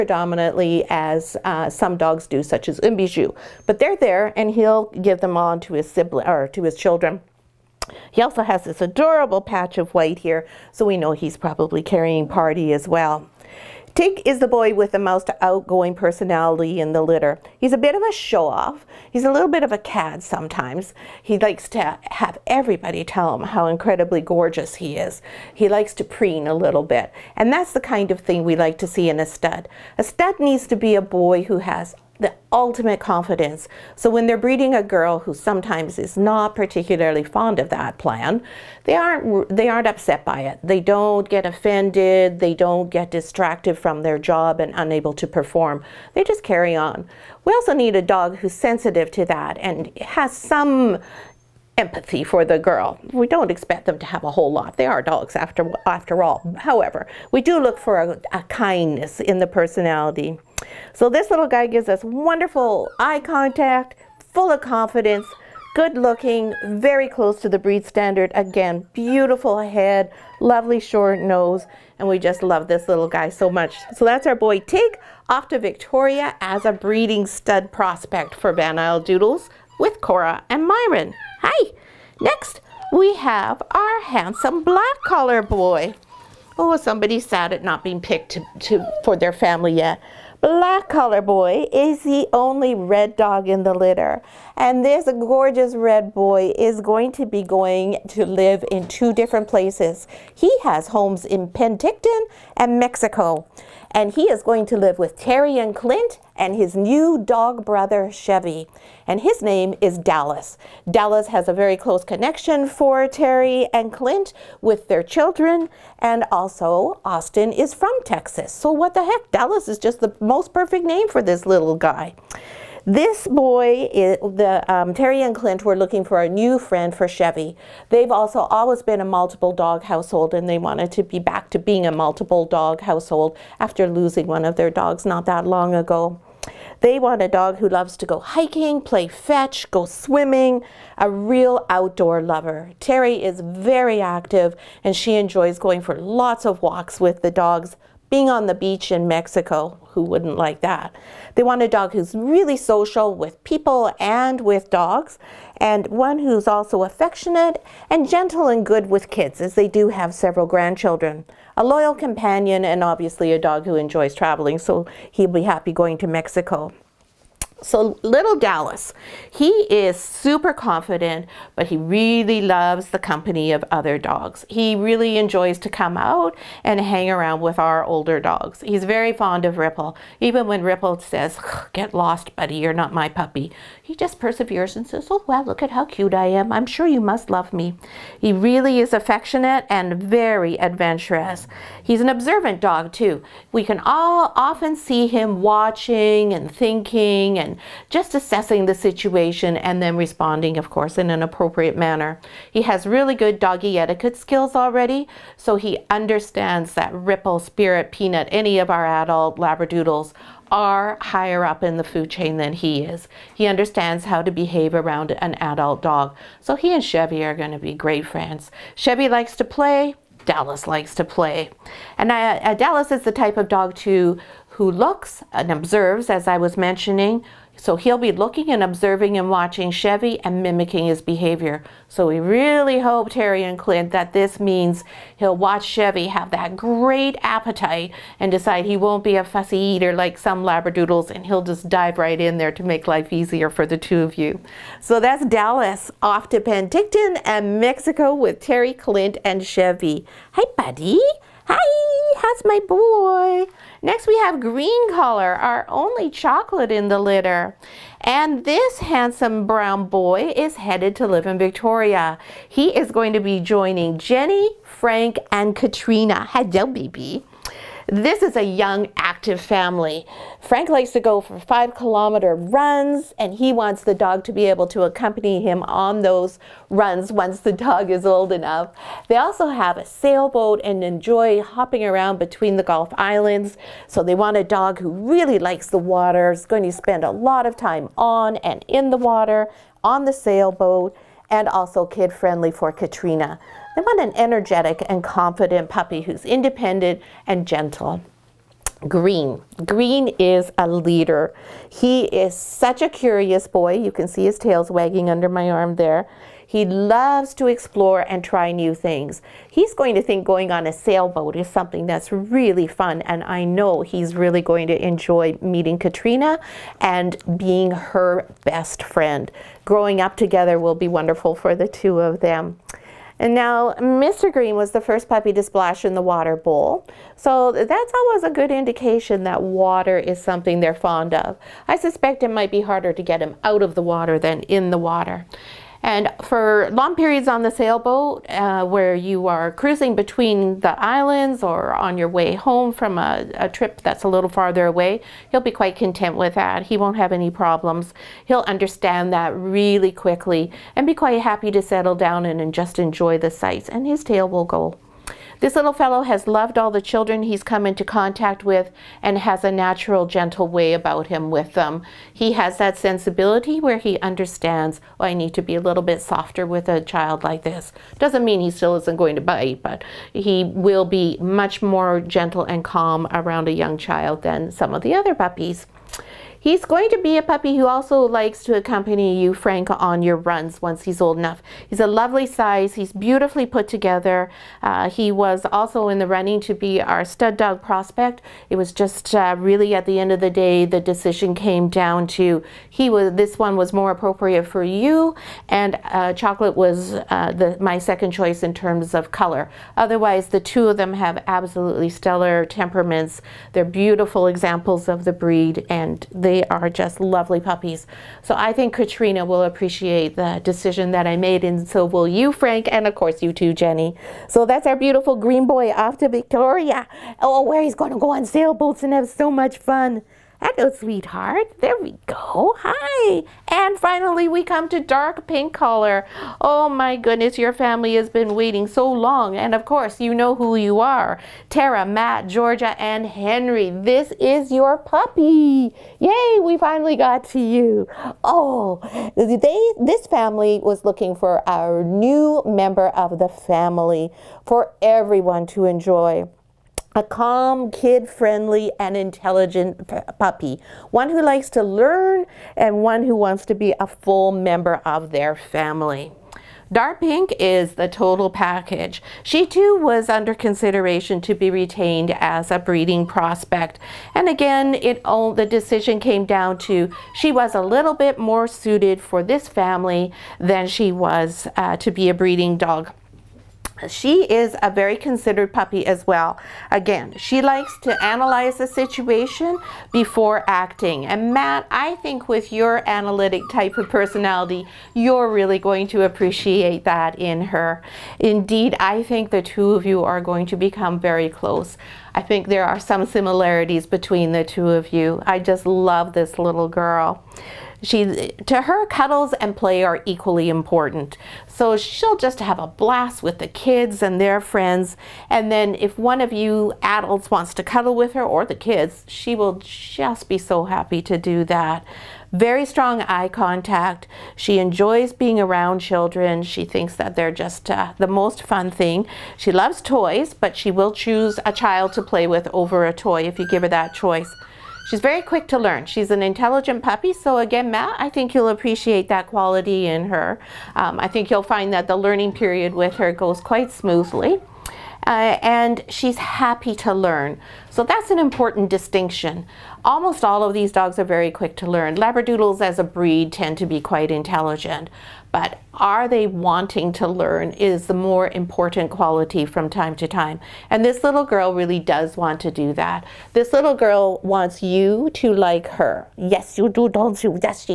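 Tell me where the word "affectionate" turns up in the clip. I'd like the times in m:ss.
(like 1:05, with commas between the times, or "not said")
2:36, 3:08.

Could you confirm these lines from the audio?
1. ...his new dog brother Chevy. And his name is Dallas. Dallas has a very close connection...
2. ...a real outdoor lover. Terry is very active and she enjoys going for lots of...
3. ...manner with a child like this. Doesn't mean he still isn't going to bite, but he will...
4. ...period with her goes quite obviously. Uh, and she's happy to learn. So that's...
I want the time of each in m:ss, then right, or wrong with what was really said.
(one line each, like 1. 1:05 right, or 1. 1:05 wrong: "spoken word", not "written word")
1. 1:46 right
2. 2:20 right
3. 6:06 wrong: "softer", not "manner"
4. 8:52 wrong: "smoothly", not "obviously".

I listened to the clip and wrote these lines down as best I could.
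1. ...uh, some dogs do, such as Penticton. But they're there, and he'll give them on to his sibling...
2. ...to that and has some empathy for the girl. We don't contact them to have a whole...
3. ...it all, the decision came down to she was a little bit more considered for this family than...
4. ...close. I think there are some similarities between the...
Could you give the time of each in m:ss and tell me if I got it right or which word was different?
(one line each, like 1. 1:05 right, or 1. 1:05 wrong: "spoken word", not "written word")
1. 0:01 wrong: "Umbiju", not "Penticton"
2. 0:49 wrong: "expect", not "contact"
3. 7:44 wrong: "suited", not "considered"
4. 8:11 right.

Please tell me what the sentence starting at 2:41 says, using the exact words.
A loyal companion, and obviously a dog who enjoys traveling, so he'll be happy going to Mexico.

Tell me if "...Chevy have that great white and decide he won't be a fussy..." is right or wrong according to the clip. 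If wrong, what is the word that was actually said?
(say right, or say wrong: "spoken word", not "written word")
wrong: "appetite", not "white".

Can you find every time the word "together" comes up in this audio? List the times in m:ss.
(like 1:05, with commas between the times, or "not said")
5:20, 6:23.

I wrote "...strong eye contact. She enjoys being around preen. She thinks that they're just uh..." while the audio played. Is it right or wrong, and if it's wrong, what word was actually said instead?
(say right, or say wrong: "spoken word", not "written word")
wrong: "children", not "preen".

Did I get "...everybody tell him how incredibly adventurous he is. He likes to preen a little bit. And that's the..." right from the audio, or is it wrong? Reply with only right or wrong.
wrong.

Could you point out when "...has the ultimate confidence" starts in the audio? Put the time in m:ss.
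0:31.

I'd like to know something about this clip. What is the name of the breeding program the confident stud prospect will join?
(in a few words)
Van Isle Doodles.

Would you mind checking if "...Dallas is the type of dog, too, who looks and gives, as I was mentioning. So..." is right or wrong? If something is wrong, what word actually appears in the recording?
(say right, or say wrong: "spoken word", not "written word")
wrong: "observes", not "gives".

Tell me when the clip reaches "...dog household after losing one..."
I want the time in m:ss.
2:12.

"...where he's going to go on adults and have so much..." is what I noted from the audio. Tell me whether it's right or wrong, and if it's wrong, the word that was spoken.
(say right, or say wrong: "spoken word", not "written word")
wrong: "sailboats", not "adults".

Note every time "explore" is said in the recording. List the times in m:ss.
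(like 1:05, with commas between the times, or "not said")
5:07.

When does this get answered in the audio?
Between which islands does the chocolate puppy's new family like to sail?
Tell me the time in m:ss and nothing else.
4:42.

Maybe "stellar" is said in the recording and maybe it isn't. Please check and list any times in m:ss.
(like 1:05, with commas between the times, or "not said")
6:41.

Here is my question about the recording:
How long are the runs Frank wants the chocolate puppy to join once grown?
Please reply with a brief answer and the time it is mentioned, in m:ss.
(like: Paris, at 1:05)
5 kilometers, at 4:31.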